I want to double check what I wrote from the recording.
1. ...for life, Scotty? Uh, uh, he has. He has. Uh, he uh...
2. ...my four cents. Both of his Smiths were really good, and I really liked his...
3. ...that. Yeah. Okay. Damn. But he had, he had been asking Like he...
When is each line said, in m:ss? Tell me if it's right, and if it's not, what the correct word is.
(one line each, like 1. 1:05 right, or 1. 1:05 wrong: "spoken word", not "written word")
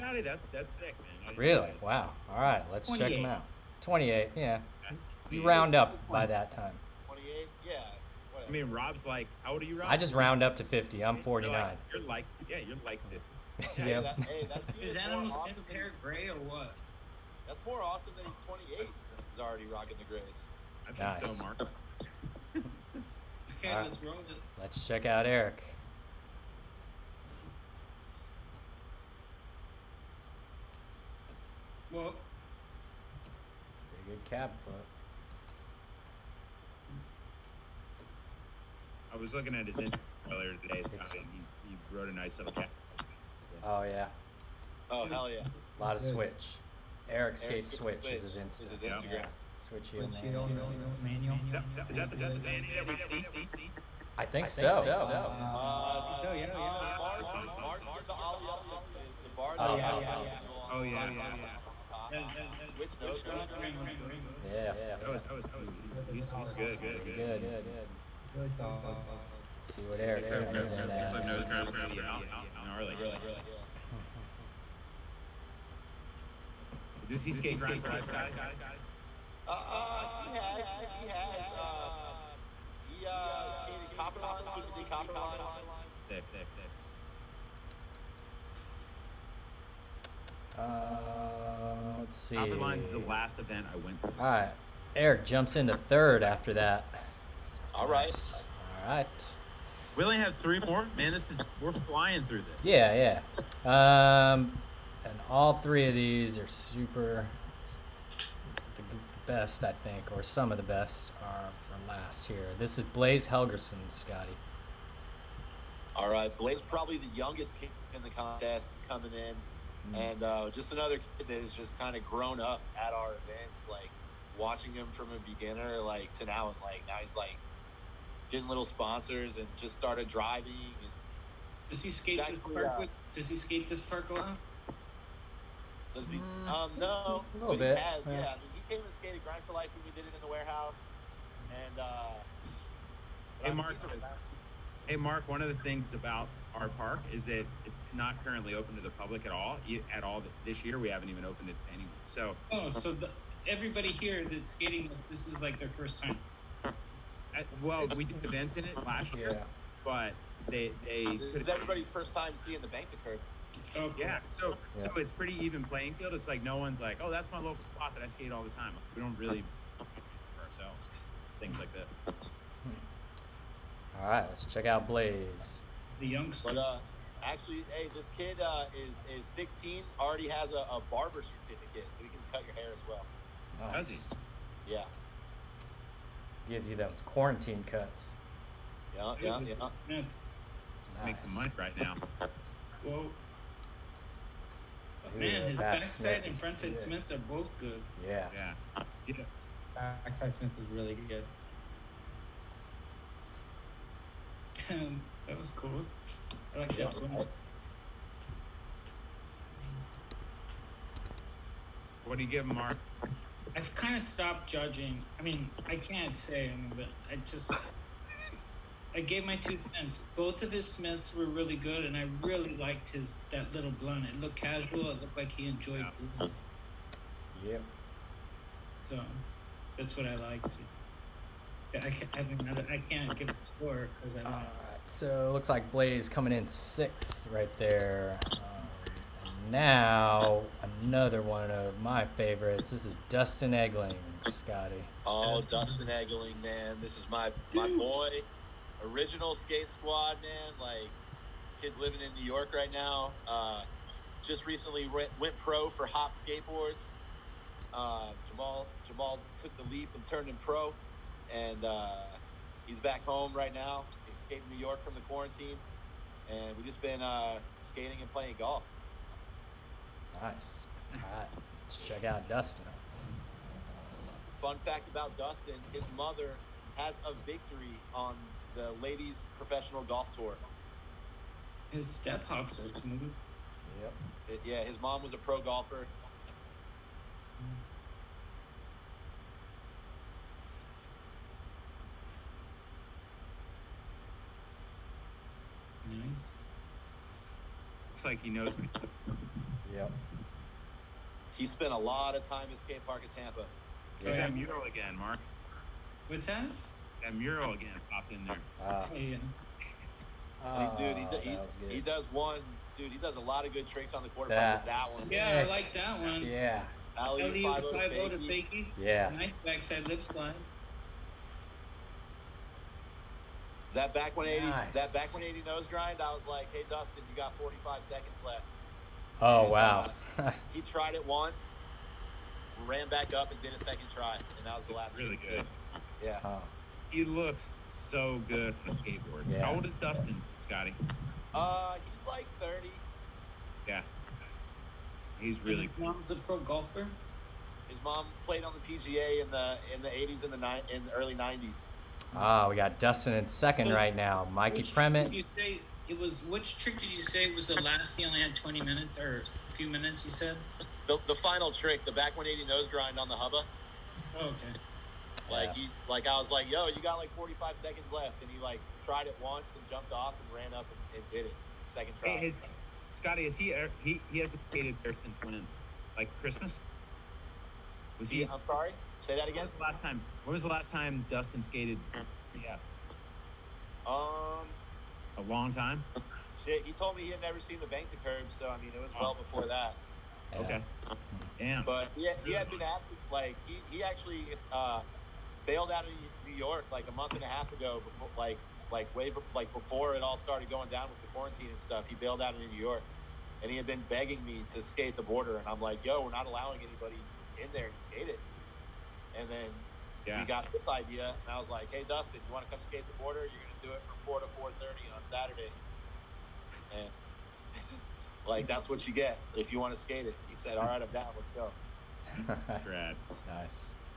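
1. 1:17 right
2. 3:39 wrong: "two", not "four"
3. 6:29 right.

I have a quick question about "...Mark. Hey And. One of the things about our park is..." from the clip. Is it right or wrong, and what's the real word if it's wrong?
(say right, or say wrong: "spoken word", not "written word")
wrong: "Mark", not "And".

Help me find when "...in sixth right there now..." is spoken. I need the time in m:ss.
3:56.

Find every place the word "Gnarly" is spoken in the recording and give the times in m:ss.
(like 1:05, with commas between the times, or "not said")
1:12.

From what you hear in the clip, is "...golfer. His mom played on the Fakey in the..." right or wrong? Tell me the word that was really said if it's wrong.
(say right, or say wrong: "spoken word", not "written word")
wrong: "PGA", not "Fakey".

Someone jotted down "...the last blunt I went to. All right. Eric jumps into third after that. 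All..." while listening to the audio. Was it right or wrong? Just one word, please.
wrong.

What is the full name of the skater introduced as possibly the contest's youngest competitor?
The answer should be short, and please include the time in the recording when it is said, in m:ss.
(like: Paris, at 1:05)
Blaze Helgerson, at 1:52.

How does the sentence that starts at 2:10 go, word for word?
And does he skate this park?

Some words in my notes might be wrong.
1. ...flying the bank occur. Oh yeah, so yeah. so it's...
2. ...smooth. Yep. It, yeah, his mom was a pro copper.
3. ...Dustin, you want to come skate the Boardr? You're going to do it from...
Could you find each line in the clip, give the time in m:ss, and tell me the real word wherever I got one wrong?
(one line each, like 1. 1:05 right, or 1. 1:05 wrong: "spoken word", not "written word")
1. 2:42 wrong: "seeing", not "flying"
2. 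4:42 wrong: "golfer", not "copper"
3. 6:51 right.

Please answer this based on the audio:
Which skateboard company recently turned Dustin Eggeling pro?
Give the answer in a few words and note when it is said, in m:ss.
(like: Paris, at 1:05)
Hopps Skateboards, at 4:15.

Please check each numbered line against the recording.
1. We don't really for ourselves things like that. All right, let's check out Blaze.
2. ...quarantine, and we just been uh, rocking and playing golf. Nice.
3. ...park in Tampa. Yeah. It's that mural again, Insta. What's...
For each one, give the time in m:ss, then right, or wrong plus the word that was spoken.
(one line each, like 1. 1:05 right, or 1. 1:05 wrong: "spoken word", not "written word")
1. 2:48 right
2. 4:25 wrong: "skating", not "rocking"
3. 5:02 wrong: "Mark", not "Insta".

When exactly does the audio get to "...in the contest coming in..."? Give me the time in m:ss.
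1:57.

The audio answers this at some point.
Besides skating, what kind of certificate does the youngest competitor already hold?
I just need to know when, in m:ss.
3:00.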